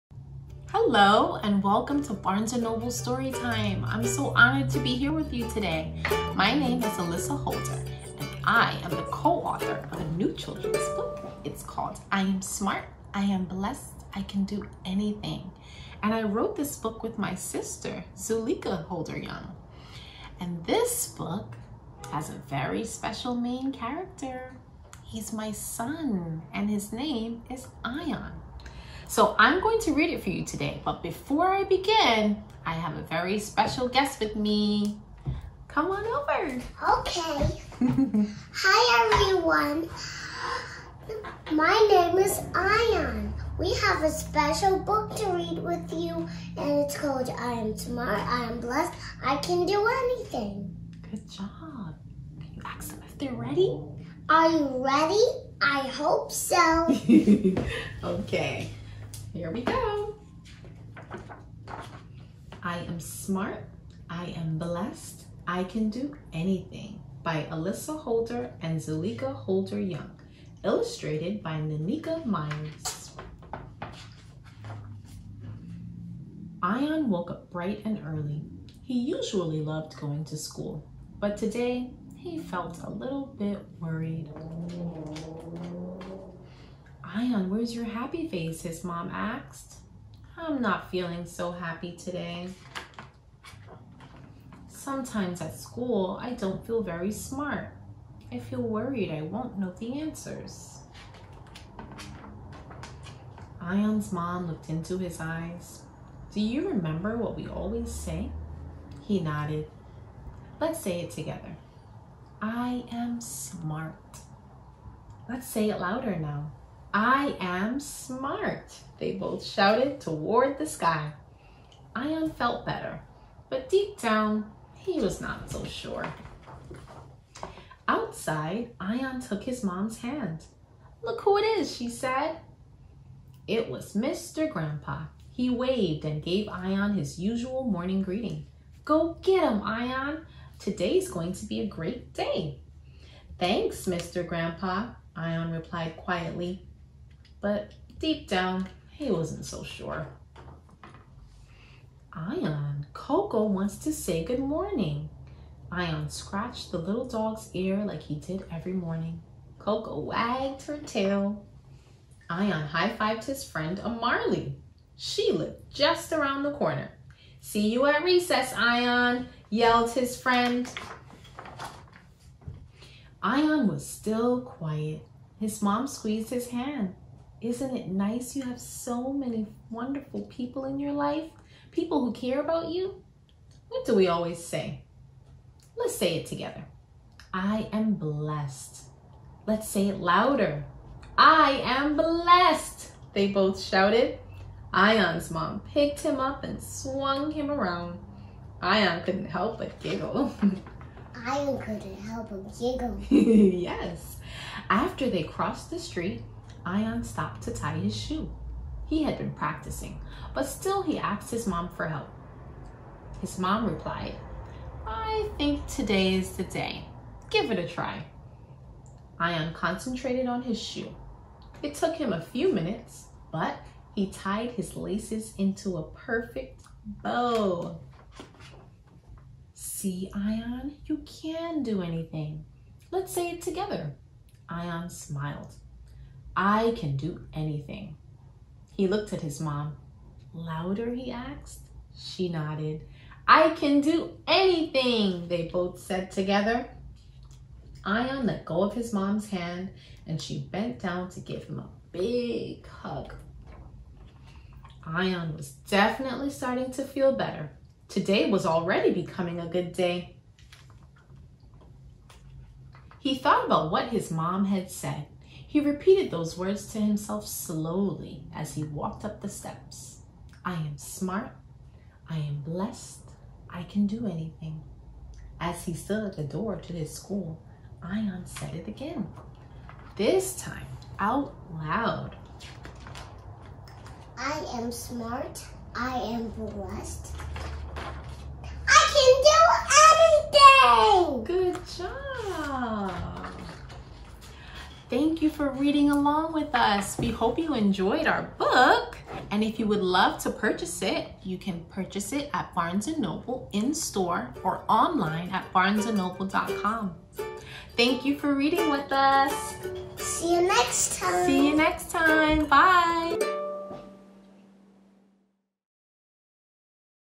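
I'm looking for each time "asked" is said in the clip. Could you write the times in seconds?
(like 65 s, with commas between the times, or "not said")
89 s, 210 s, 241 s.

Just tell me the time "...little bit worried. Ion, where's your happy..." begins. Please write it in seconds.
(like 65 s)
82 s.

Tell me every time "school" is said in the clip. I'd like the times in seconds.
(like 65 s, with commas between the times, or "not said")
80 s, 95 s, 276 s.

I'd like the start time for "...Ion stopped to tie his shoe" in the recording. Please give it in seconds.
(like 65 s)
206 s.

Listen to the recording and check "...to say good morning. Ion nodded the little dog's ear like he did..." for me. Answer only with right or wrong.
wrong.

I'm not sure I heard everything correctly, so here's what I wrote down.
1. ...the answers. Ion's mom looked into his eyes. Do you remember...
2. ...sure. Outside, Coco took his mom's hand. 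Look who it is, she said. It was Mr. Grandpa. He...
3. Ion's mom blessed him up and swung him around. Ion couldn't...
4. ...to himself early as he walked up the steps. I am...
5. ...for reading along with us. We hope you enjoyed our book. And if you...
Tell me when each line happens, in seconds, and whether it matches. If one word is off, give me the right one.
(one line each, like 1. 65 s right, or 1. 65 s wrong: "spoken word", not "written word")
1. 99 s right
2. 125 s wrong: "Ion", not "Coco"
3. 194 s wrong: "picked", not "blessed"
4. 266 s wrong: "slowly", not "early"
5. 295 s right.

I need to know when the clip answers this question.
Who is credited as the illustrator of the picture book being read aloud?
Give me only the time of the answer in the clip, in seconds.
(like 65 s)
71 s.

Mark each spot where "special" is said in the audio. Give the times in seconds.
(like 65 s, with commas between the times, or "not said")
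22 s, 33 s, 44 s.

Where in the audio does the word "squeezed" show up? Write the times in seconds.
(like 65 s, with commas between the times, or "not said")
175 s.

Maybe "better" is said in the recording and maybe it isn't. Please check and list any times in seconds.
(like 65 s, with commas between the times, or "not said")
122 s, 257 s.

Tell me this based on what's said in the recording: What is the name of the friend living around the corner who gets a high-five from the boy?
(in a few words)
Amarly.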